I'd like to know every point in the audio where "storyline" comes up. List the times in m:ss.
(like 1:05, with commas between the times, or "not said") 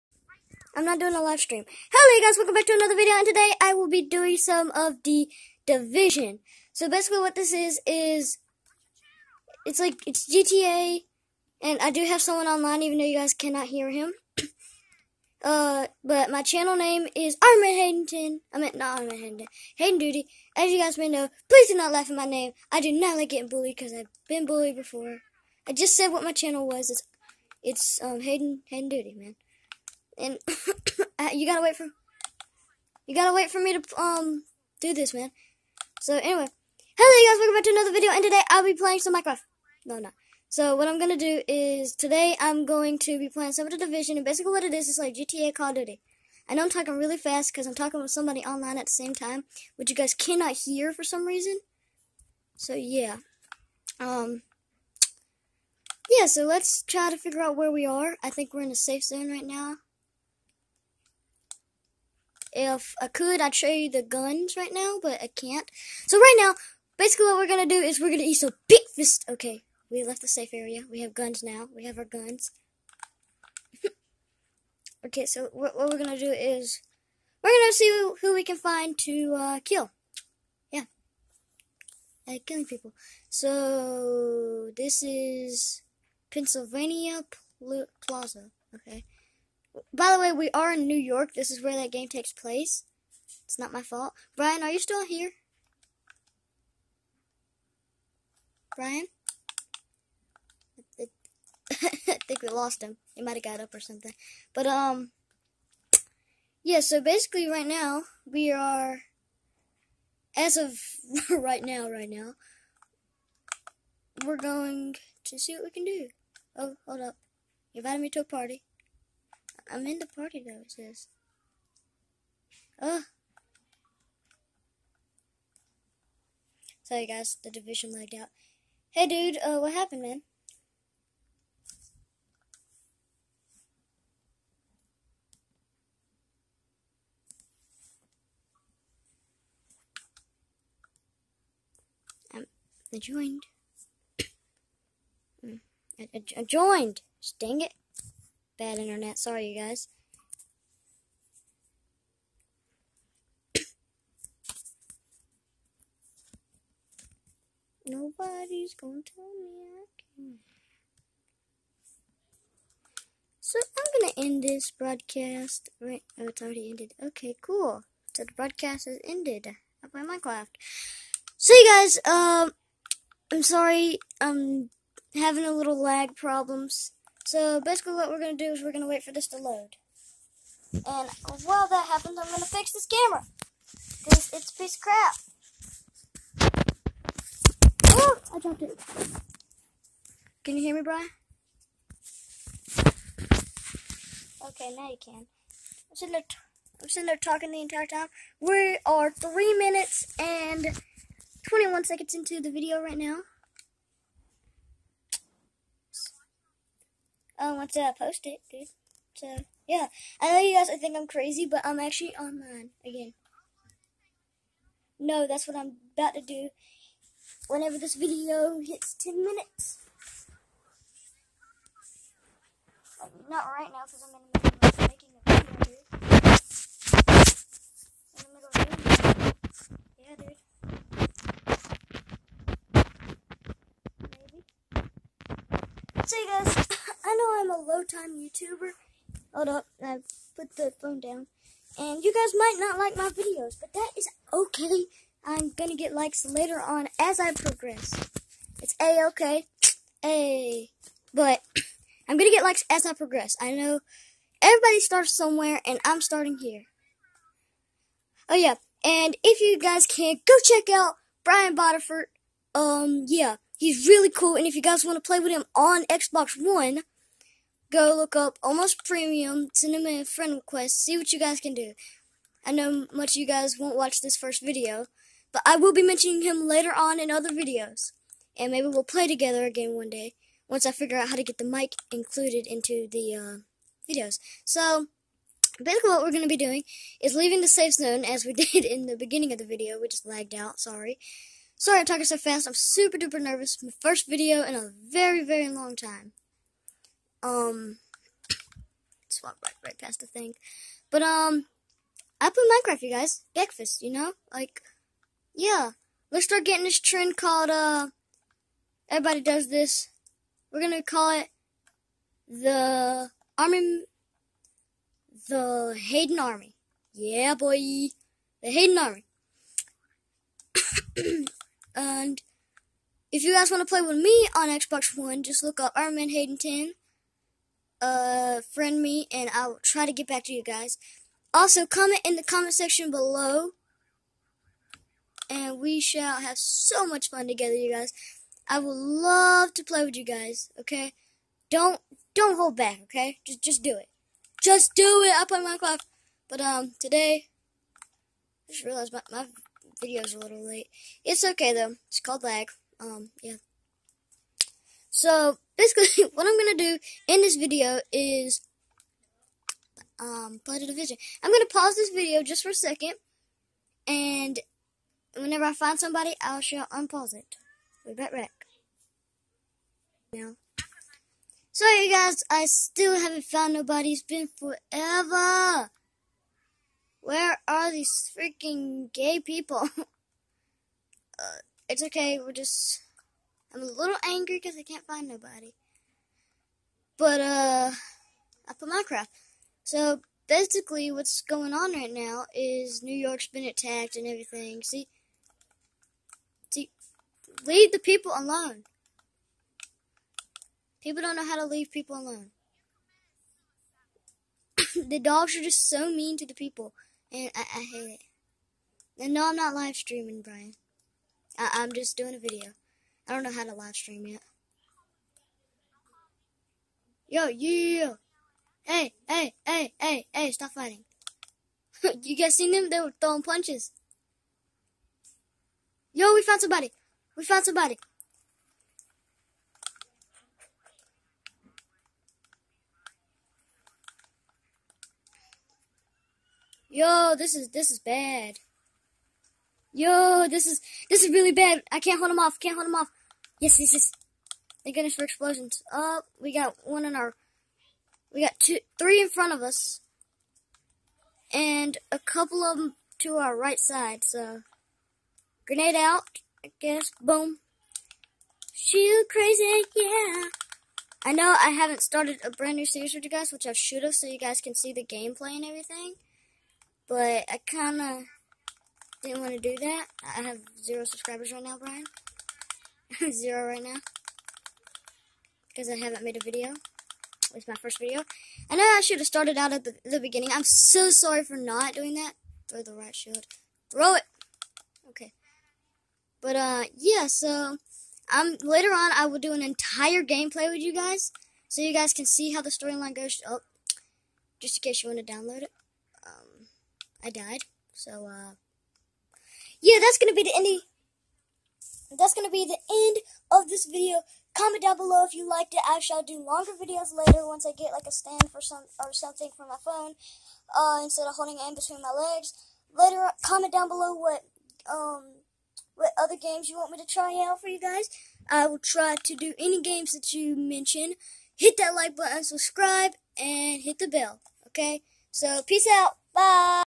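8:12.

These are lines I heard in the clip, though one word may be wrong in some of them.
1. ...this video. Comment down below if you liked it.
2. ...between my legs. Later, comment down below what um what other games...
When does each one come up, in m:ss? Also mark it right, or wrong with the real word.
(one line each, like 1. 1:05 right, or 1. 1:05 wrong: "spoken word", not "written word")
1. 8:23 right
2. 8:31 right.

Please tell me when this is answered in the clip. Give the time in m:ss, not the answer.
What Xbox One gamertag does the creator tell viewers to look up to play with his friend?
4:28.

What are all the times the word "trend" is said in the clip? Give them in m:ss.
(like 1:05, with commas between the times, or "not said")
5:06.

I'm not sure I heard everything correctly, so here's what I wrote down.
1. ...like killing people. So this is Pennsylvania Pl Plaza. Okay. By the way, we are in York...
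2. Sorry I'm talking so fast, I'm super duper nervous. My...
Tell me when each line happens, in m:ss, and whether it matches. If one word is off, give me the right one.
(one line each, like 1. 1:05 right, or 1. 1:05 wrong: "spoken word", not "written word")
1. 1:22 wrong: "New", not "York"
2. 4:51 right.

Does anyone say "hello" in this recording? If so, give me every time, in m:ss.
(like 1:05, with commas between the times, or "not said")
0:01, 0:36.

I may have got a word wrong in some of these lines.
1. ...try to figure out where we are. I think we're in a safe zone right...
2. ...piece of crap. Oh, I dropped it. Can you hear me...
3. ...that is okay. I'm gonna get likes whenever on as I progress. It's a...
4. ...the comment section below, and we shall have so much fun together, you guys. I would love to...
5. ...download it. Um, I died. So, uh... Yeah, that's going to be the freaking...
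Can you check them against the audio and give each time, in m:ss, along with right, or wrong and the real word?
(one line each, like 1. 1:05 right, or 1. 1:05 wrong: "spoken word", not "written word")
1. 0:56 right
2. 3:04 right
3. 4:03 wrong: "later", not "whenever"
4. 5:32 right
5. 8:15 wrong: "ending", not "freaking".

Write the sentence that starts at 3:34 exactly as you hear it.
No, that's what I'm about to do whenever this video hits 10 minutes.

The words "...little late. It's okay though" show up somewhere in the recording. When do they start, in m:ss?
5:50.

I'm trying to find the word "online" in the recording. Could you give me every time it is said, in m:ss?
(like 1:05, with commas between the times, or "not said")
0:12, 0:48, 3:32.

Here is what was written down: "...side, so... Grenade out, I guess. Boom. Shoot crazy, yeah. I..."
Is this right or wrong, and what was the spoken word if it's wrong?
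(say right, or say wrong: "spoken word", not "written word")
right.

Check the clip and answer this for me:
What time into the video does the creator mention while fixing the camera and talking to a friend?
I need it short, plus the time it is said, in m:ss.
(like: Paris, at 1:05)
3 minutes 21 seconds, at 3:19.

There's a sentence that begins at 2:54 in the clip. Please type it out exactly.
I'm having a little lag problems.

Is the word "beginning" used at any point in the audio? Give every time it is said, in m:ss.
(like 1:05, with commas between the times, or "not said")
4:48, 7:59.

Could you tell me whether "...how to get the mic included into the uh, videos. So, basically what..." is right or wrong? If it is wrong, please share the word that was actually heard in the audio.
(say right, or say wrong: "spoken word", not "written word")
right.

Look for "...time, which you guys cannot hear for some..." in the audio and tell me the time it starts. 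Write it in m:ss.
0:49.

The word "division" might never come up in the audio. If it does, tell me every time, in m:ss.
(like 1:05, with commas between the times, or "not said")
0:05, 0:43, 2:07, 6:00.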